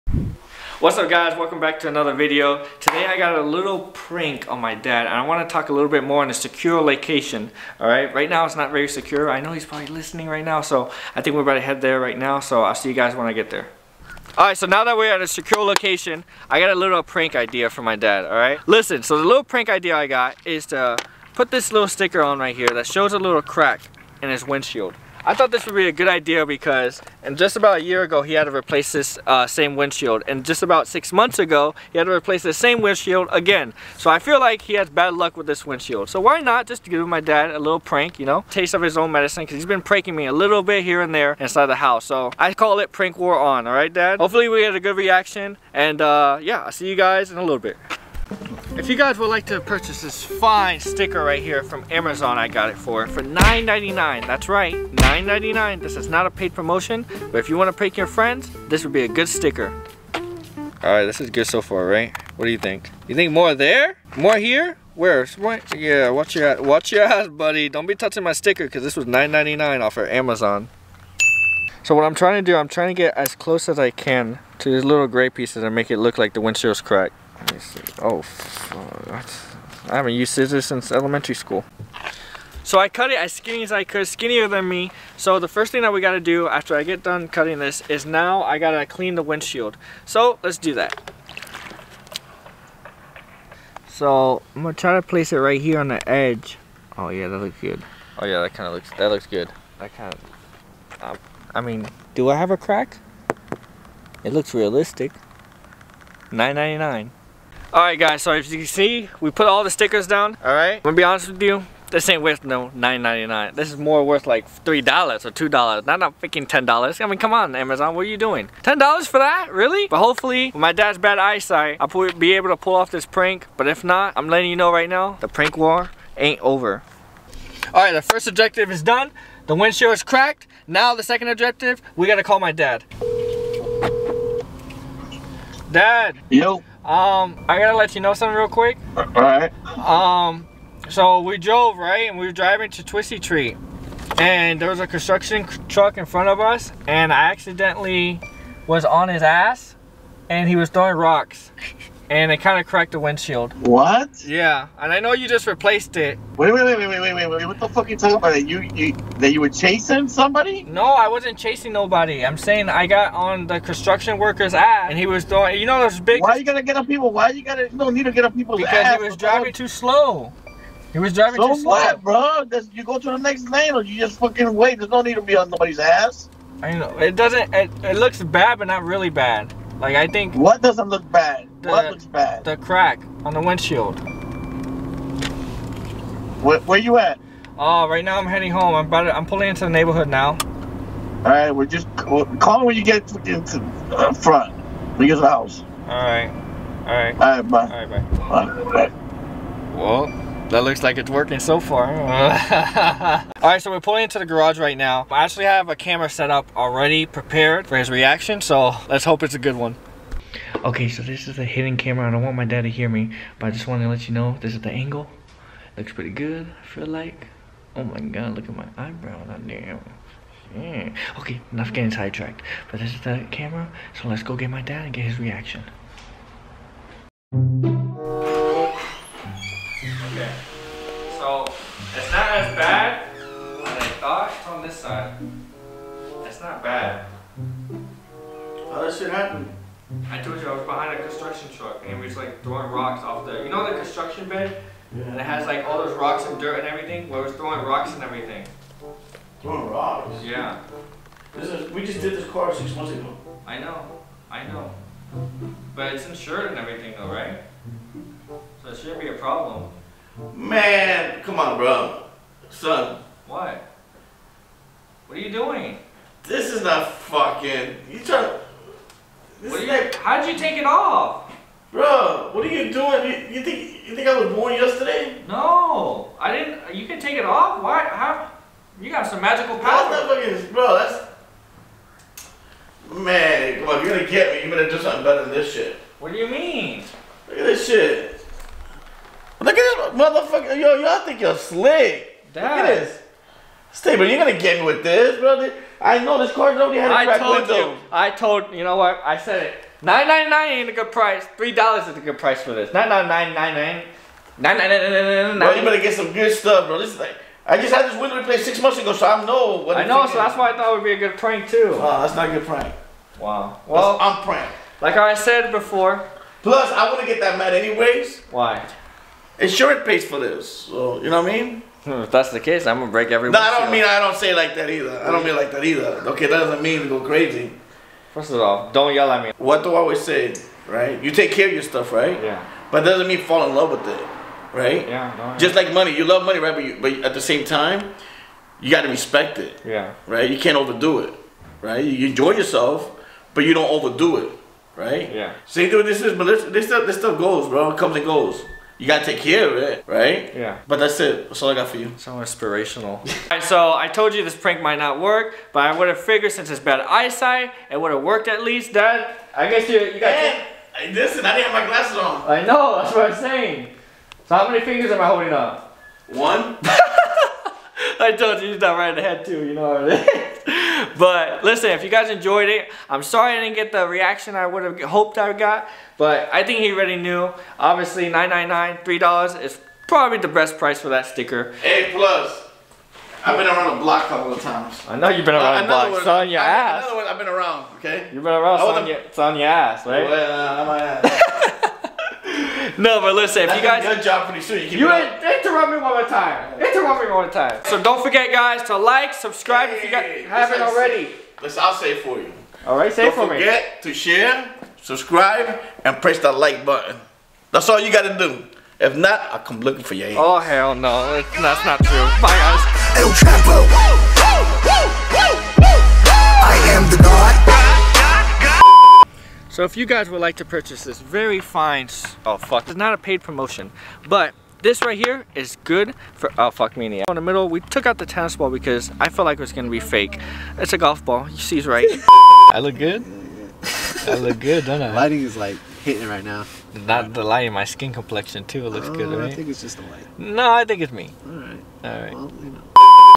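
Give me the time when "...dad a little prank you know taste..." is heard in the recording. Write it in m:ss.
0:37.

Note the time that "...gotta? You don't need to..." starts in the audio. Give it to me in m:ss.
2:47.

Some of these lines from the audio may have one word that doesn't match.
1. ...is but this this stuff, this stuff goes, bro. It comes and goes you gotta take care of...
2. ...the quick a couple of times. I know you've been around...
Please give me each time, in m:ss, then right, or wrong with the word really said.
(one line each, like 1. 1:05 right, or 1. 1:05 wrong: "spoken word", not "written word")
1. 5:46 right
2. 6:23 wrong: "block", not "quick".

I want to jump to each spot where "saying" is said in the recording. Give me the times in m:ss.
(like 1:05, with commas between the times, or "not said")
2:42, 6:03.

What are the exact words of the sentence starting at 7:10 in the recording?
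It's a golf ball, you see, right.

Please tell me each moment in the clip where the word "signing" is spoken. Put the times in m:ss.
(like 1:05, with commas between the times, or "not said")
not said.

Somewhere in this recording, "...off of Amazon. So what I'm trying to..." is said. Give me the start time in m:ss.
1:09.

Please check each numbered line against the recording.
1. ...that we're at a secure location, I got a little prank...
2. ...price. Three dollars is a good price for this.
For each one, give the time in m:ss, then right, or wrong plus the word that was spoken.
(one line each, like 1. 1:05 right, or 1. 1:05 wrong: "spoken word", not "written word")
1. 0:14 right
2. 5:00 right.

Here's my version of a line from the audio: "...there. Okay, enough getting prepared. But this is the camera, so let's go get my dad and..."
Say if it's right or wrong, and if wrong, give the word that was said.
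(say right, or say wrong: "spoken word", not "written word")
wrong: "sidetracked", not "prepared".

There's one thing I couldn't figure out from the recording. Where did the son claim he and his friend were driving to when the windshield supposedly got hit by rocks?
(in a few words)
Twistee Treat.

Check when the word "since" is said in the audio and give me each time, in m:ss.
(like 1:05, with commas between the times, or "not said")
1:20, 5:56.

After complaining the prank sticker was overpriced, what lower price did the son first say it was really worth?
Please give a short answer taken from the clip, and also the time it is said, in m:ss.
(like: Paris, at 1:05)
$3 or $2, at 1:54.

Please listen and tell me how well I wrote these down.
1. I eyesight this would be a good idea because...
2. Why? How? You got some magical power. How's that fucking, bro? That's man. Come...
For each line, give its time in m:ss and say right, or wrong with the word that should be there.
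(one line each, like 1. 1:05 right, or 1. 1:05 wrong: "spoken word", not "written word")
1. 0:25 wrong: "thought", not "eyesight"
2. 4:37 right.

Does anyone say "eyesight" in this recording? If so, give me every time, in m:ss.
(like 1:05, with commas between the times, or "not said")
2:01, 5:56.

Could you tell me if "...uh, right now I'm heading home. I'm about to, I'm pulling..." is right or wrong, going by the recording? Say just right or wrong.
right.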